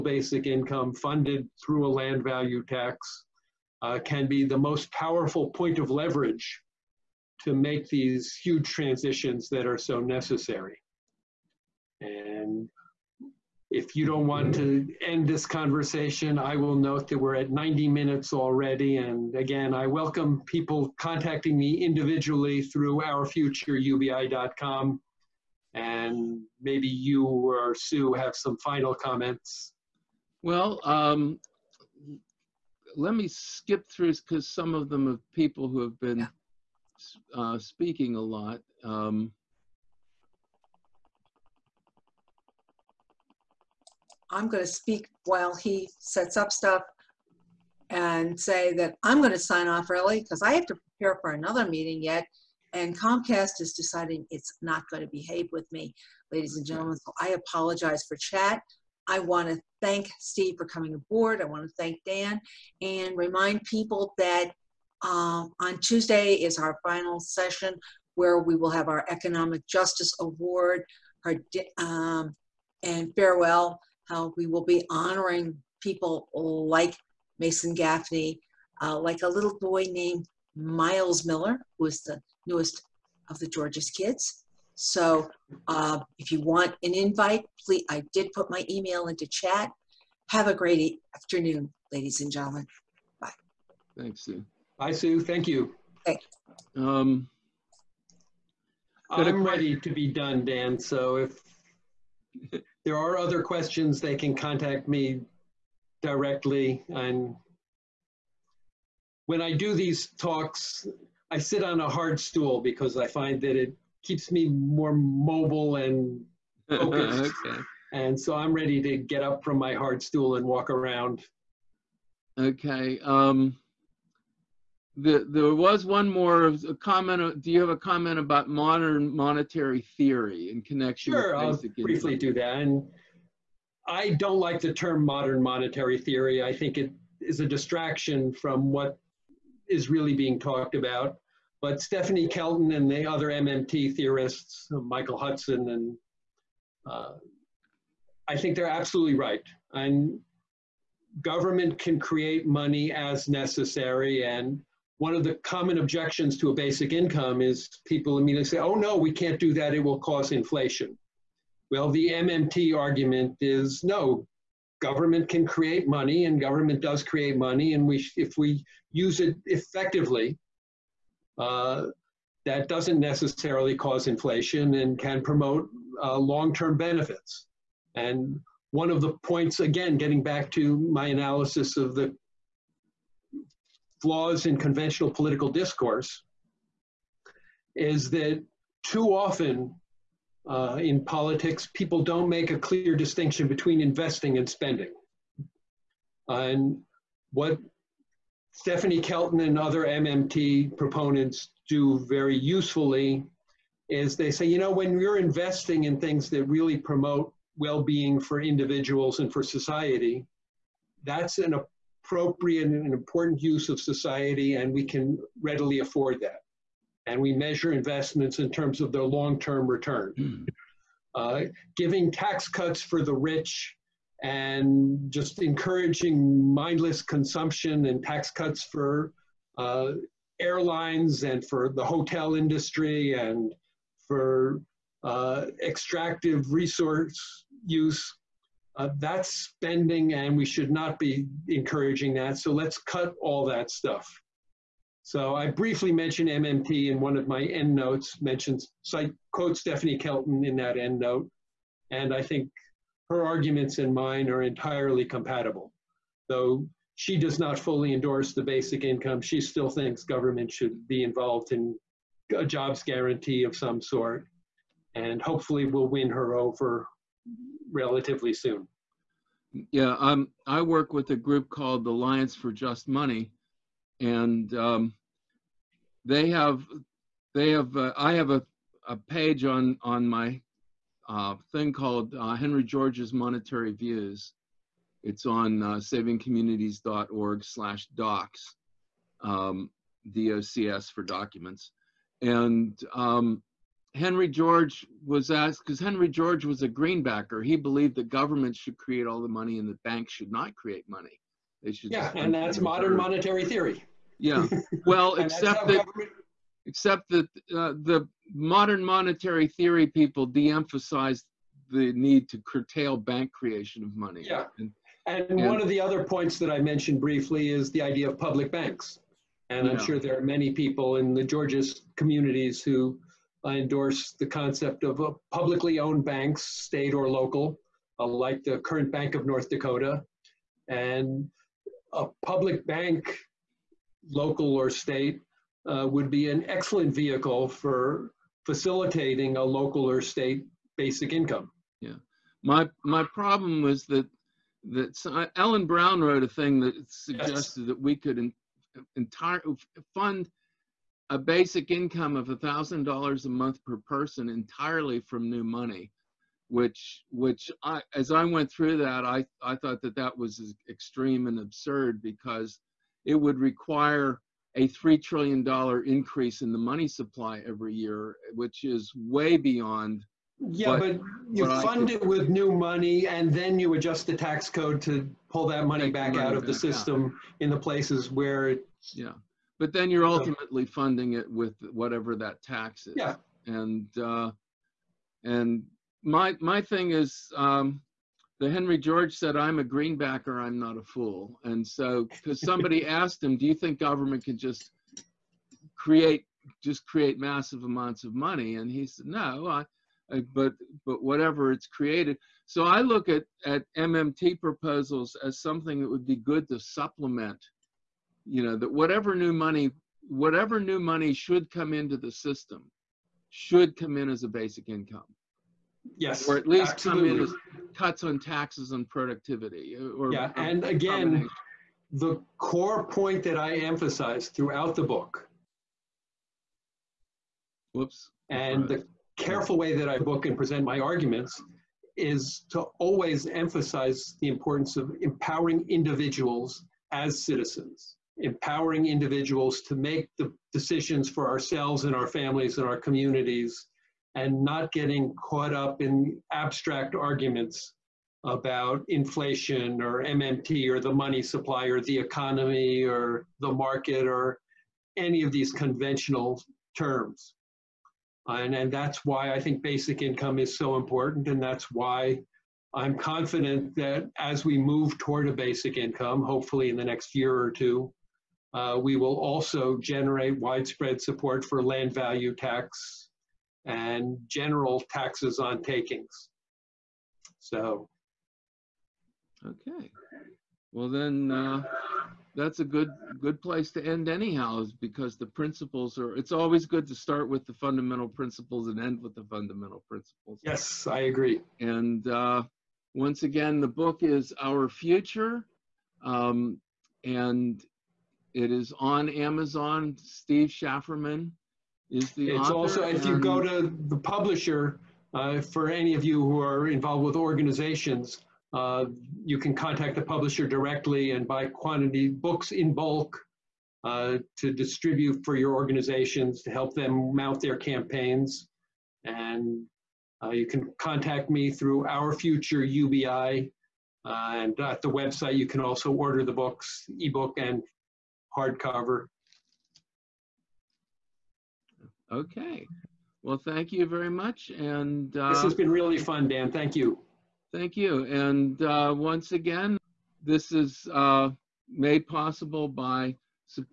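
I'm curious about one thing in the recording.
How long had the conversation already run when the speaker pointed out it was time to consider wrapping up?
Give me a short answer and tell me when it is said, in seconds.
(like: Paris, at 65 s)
90 minutes, at 17 s.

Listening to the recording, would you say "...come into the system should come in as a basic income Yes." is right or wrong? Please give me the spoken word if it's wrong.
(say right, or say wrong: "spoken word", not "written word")
right.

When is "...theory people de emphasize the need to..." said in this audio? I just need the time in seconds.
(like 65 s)
309 s.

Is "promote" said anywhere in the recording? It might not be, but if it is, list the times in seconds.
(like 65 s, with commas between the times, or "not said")
175 s, 206 s.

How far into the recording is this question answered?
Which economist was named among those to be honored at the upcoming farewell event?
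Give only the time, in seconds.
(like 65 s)
77 s.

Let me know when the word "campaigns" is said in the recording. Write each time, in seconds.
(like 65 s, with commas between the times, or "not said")
517 s.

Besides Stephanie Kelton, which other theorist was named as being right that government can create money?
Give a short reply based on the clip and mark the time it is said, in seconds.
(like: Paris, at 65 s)
Michael Hudson, at 144 s.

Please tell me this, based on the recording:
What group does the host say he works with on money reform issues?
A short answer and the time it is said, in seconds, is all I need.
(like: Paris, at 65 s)
Alliance for Just Money, at 271 s.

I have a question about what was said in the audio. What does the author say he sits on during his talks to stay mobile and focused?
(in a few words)
a hard stool.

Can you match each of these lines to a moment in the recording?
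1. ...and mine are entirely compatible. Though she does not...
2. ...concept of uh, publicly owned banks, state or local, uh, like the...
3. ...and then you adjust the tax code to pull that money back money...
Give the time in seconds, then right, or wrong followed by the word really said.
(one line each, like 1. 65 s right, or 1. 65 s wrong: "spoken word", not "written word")
1. 253 s right
2. 324 s right
3. 373 s right.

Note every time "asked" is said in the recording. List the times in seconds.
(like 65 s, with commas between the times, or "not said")
295 s, 392 s.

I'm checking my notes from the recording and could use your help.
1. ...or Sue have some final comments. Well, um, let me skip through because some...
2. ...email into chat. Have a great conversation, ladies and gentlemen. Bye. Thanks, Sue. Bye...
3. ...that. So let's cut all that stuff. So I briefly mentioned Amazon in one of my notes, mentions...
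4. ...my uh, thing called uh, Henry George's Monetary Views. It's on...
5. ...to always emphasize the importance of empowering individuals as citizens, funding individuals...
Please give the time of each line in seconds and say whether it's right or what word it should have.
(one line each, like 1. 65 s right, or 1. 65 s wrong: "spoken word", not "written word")
1. 27 s right
2. 88 s wrong: "afternoon", not "conversation"
3. 242 s wrong: "MMT", not "Amazon"
4. 280 s right
5. 432 s wrong: "empowering", not "funding".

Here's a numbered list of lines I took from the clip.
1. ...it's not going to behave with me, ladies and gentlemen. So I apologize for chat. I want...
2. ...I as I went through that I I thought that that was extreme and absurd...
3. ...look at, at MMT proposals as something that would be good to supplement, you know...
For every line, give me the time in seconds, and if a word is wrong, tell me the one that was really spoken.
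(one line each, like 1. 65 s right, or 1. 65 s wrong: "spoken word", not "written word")
1. 54 s right
2. 357 s right
3. 402 s right.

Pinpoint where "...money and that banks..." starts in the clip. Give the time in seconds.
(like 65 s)
299 s.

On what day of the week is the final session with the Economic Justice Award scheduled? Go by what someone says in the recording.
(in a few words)
Tuesday.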